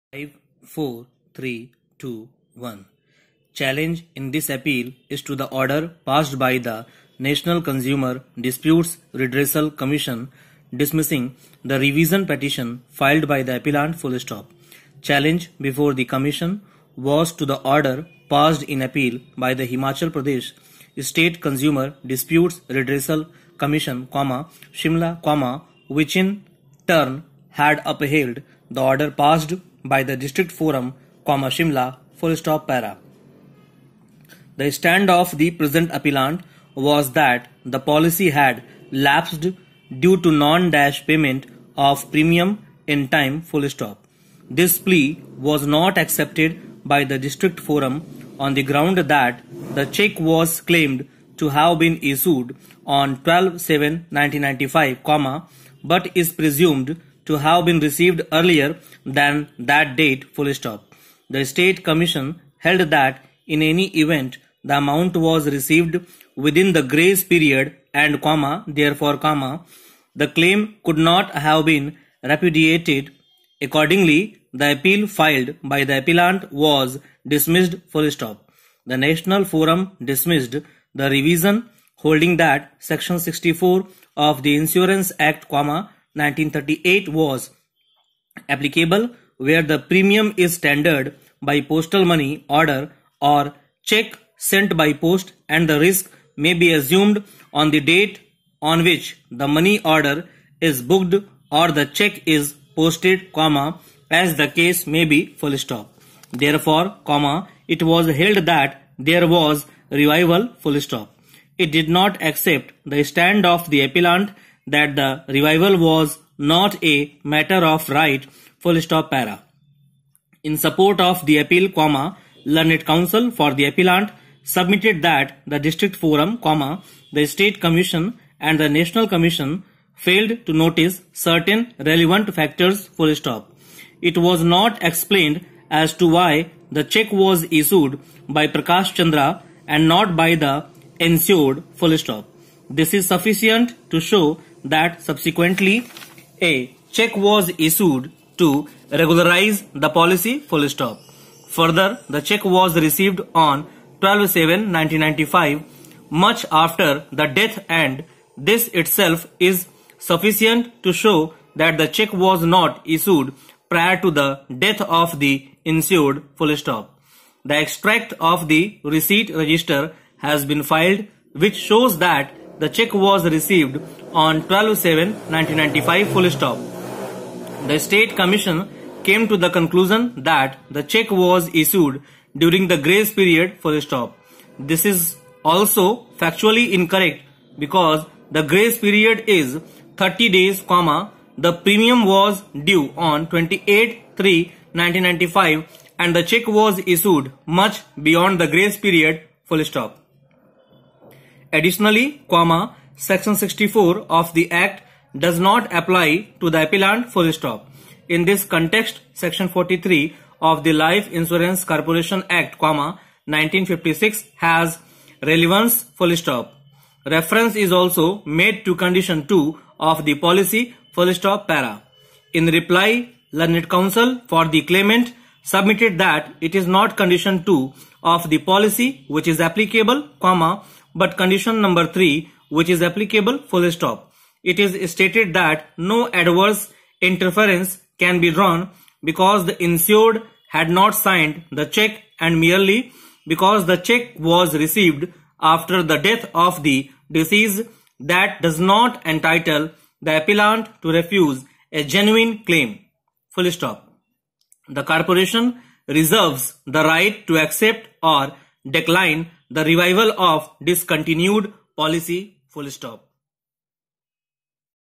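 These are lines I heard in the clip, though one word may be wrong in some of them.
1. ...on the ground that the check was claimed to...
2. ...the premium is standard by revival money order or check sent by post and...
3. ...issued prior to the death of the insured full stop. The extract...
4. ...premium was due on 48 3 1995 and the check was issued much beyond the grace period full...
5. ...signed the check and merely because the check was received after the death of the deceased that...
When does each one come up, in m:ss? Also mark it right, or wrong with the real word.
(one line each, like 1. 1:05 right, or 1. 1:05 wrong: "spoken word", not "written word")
1. 0:48 right
2. 1:29 wrong: "postal", not "revival"
3. 2:42 right
4. 3:11 wrong: "28", not "48"
5. 4:00 right.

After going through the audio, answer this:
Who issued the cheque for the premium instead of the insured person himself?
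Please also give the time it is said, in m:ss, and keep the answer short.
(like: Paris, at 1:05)
Prakash Chandra, at 2:18.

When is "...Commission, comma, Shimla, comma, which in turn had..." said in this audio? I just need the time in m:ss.
0:23.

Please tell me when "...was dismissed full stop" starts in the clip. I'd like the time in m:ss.
1:16.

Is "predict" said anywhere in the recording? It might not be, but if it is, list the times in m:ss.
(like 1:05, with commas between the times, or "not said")
not said.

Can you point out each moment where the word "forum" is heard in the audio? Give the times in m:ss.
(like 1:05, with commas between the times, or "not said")
0:30, 0:47, 1:19, 2:05.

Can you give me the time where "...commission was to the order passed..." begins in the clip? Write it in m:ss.
0:16.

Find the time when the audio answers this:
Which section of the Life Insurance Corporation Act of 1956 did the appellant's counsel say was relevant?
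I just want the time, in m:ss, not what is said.
3:29.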